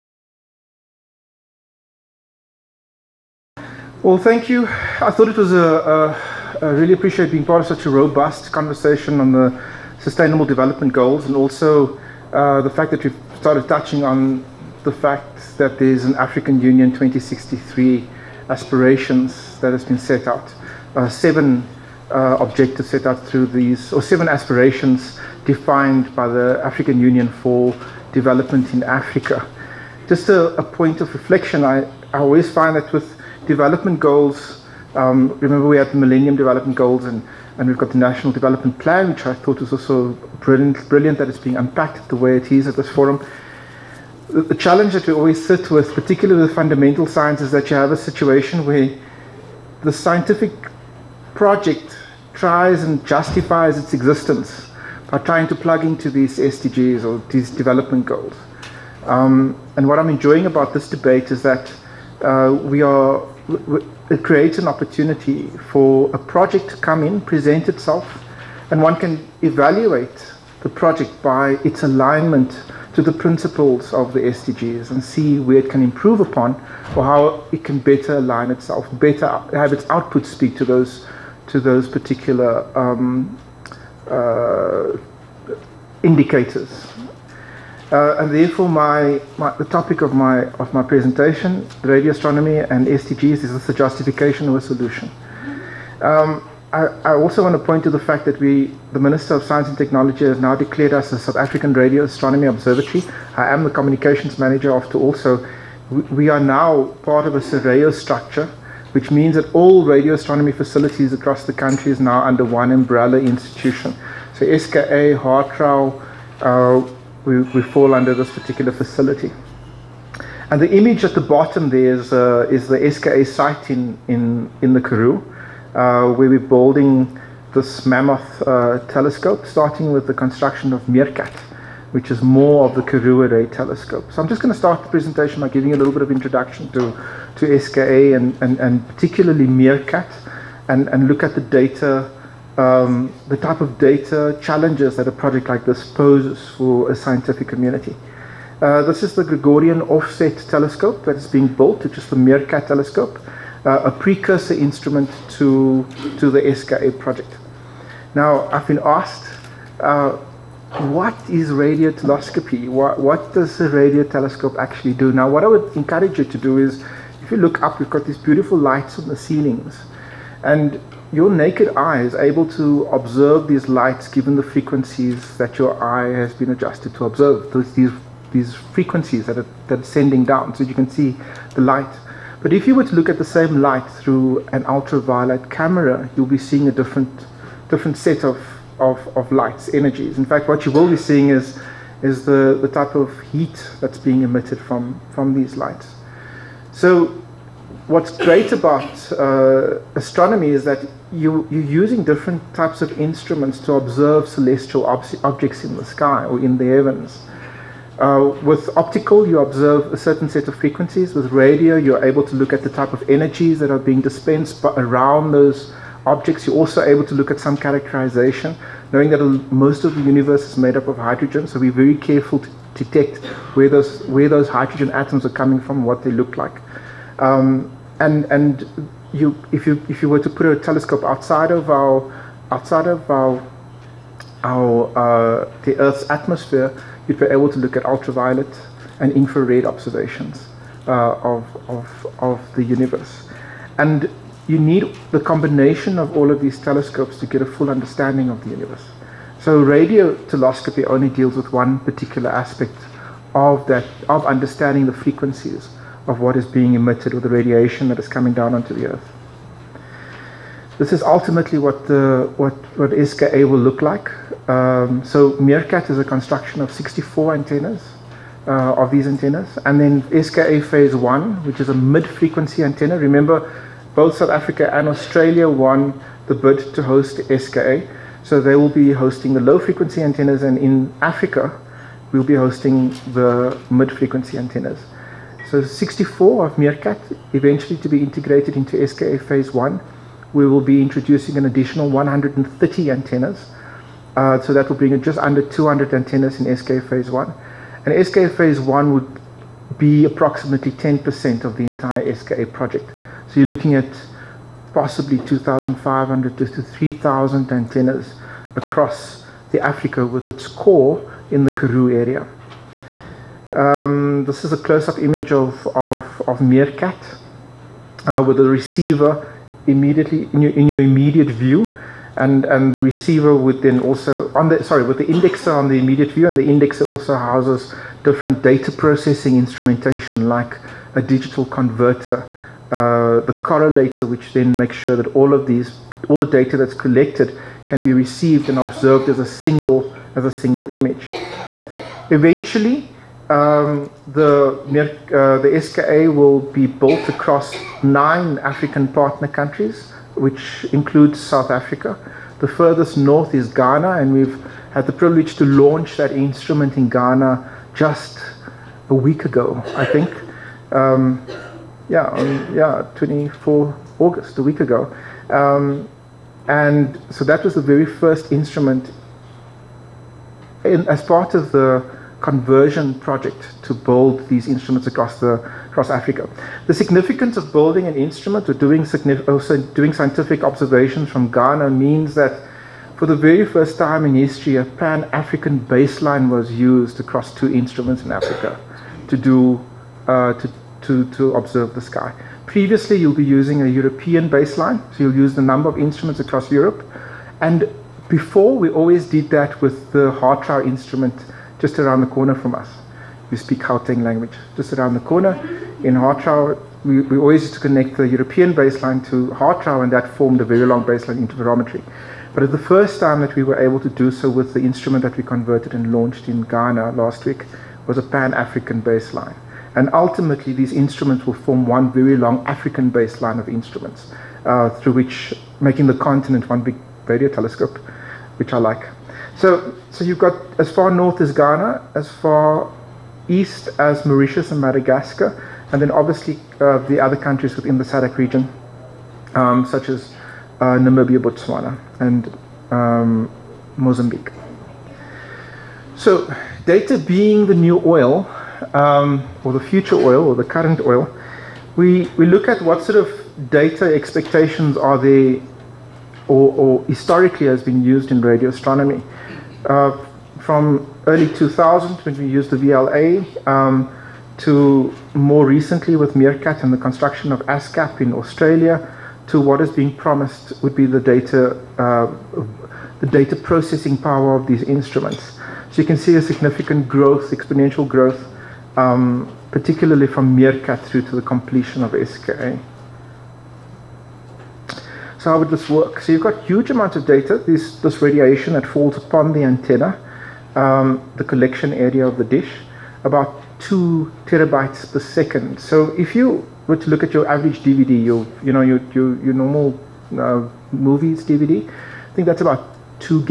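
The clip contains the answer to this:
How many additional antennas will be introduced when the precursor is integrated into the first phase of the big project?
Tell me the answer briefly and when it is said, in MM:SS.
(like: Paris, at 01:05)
130, at 04:51.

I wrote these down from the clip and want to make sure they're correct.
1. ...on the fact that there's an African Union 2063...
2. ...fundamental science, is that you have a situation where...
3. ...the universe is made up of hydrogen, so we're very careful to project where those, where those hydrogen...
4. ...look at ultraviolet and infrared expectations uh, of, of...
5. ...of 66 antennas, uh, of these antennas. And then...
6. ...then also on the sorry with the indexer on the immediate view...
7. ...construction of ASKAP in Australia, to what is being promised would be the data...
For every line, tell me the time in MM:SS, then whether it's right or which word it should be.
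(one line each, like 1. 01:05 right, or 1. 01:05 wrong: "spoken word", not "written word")
1. 00:14 right
2. 00:46 right
3. 03:39 wrong: "detect", not "project"
4. 03:57 wrong: "observations", not "expectations"
5. 04:26 wrong: "64", not "66"
6. 05:23 right
7. 07:46 right.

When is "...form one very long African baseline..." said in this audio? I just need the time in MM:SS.
07:01.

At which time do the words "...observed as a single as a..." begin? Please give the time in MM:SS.
05:38.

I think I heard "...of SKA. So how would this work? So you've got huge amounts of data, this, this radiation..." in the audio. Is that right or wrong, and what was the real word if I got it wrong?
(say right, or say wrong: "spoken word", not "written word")
right.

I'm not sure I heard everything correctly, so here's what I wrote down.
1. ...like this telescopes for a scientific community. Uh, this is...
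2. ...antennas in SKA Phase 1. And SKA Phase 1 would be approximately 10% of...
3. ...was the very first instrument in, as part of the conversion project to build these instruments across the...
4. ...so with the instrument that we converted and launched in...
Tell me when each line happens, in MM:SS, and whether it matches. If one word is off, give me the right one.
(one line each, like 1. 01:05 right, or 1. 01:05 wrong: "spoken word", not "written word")
1. 02:25 wrong: "poses", not "telescopes"
2. 04:55 right
3. 06:07 right
4. 06:54 right.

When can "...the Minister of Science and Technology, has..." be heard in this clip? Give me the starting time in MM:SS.
01:38.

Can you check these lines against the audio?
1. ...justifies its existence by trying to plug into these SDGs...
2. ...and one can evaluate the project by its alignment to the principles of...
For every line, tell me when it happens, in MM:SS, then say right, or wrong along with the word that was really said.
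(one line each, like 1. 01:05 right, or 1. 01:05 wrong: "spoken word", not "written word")
1. 00:53 right
2. 01:08 right.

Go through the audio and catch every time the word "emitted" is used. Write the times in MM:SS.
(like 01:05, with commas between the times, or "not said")
03:14, 04:16.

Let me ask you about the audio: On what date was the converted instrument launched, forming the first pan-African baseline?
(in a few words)
24 August.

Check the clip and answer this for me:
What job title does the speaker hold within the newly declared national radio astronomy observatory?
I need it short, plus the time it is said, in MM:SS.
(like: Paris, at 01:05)
Communications manager, at 01:43.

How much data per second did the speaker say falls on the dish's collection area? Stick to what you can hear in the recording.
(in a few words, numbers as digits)
2 terabytes.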